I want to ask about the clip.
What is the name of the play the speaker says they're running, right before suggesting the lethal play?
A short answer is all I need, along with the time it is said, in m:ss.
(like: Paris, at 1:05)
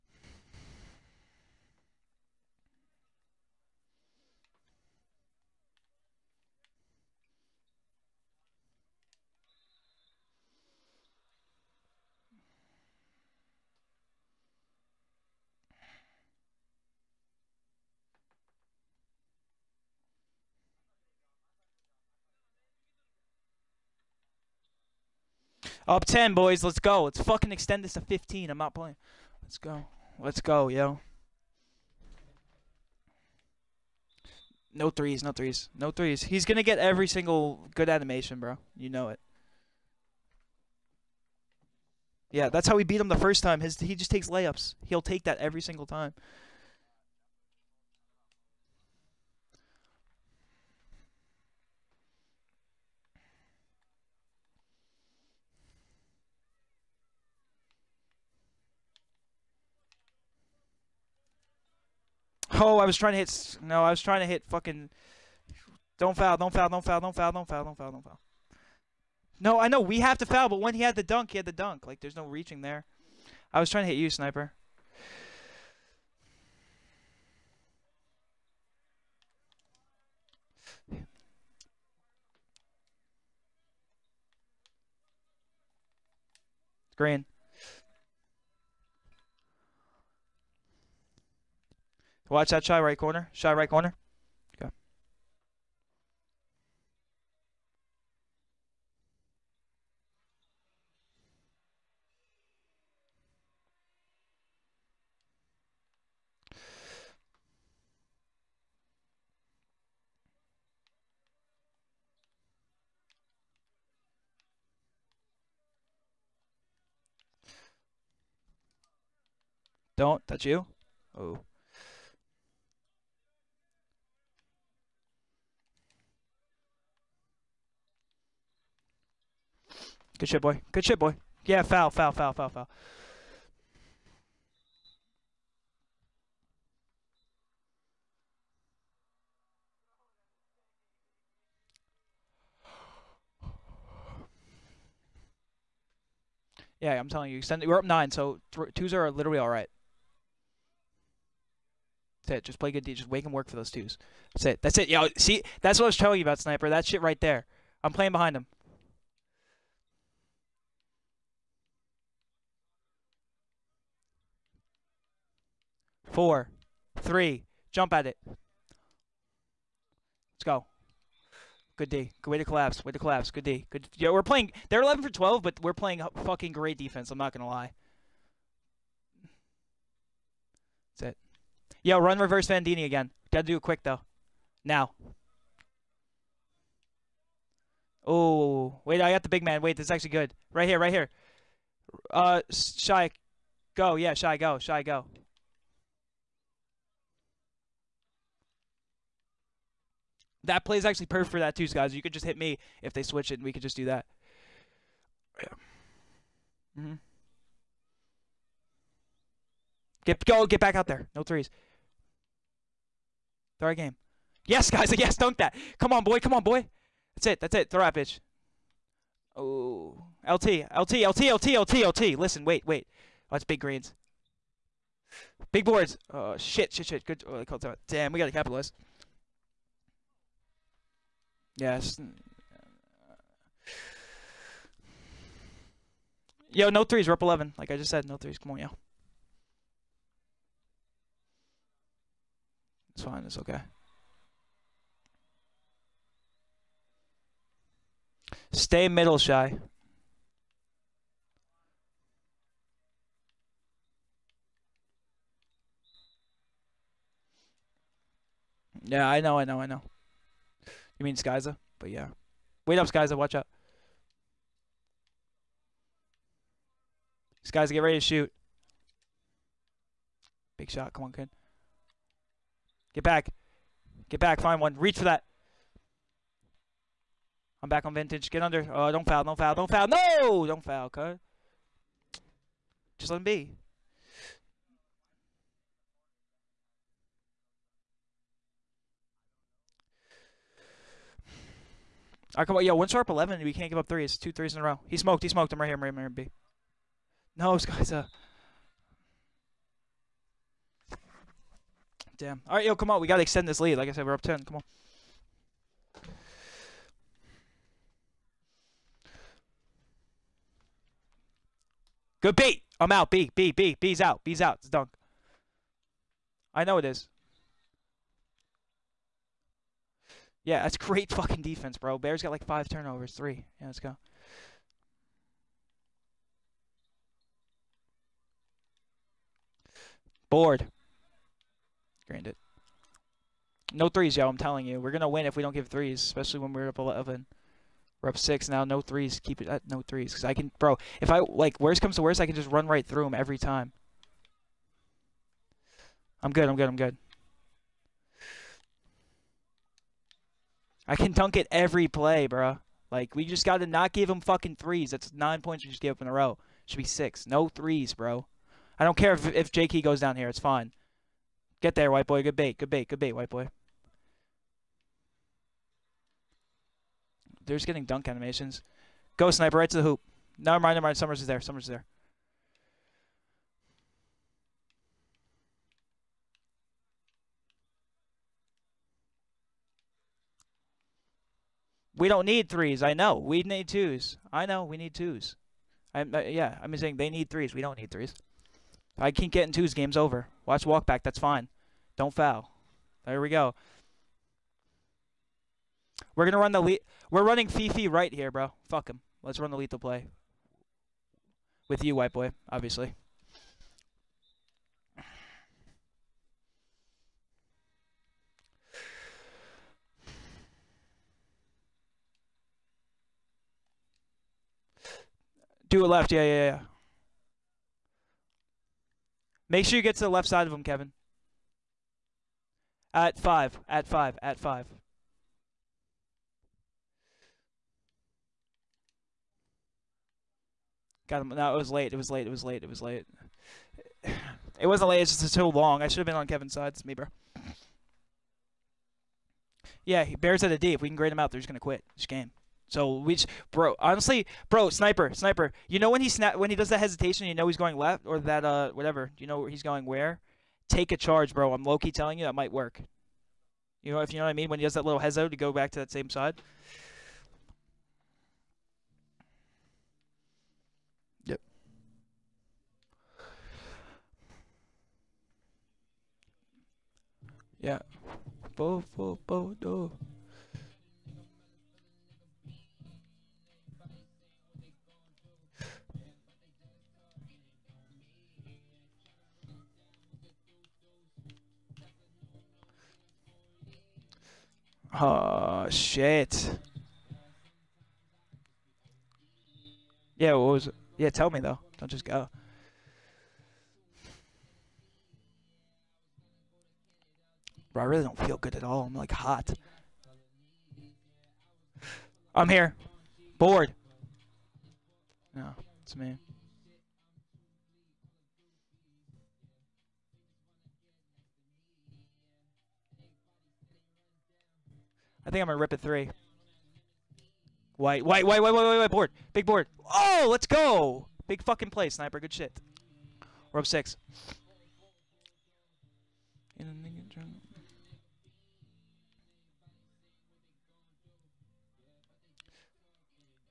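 Fifi, at 6:37.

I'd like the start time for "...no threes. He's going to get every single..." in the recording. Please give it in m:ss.
0:35.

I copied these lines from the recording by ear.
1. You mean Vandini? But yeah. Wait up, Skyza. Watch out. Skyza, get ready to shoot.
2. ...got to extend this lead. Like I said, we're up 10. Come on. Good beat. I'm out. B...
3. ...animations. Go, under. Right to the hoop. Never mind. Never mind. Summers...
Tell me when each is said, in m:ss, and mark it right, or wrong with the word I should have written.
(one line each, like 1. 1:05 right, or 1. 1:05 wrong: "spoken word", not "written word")
1. 4:20 wrong: "Skyza", not "Vandini"
2. 5:03 right
3. 6:08 wrong: "sniper", not "under".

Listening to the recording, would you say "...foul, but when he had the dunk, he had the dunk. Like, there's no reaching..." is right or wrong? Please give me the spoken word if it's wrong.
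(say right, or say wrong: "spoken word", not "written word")
right.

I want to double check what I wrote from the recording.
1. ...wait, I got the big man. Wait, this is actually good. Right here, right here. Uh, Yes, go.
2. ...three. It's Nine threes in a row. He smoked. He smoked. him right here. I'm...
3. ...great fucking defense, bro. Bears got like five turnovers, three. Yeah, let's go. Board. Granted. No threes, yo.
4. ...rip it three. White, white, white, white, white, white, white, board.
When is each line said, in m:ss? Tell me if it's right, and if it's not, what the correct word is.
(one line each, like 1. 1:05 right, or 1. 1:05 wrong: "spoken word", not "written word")
1. 3:08 wrong: "Shy", not "Yes"
2. 4:53 wrong: "Two", not "Nine"
3. 5:20 right
4. 8:35 right.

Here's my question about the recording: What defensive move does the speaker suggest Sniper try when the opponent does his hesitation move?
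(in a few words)
Take a charge.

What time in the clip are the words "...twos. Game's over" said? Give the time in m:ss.
6:29.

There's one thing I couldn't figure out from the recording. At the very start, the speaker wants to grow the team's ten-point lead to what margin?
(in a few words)
15.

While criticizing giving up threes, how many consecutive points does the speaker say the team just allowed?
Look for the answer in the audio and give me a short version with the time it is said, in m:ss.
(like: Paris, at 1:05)
9, at 5:55.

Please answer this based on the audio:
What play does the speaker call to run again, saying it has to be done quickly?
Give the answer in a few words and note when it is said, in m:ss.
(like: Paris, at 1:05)
Reverse Vandini, at 3:02.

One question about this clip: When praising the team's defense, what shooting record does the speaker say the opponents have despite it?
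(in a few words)
11 for 12.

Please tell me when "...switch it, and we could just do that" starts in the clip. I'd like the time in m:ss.
3:23.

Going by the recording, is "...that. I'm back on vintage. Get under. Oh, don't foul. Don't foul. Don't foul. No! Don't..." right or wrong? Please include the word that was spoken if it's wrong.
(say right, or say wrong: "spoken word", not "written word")
right.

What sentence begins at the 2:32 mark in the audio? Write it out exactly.
Just wake and work for those twos.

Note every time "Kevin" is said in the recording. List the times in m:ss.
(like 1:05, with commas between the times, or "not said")
7:00, 7:16.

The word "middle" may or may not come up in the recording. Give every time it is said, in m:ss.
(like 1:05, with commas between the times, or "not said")
4:08.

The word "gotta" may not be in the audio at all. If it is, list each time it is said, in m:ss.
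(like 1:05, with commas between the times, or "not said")
3:03, 3:48.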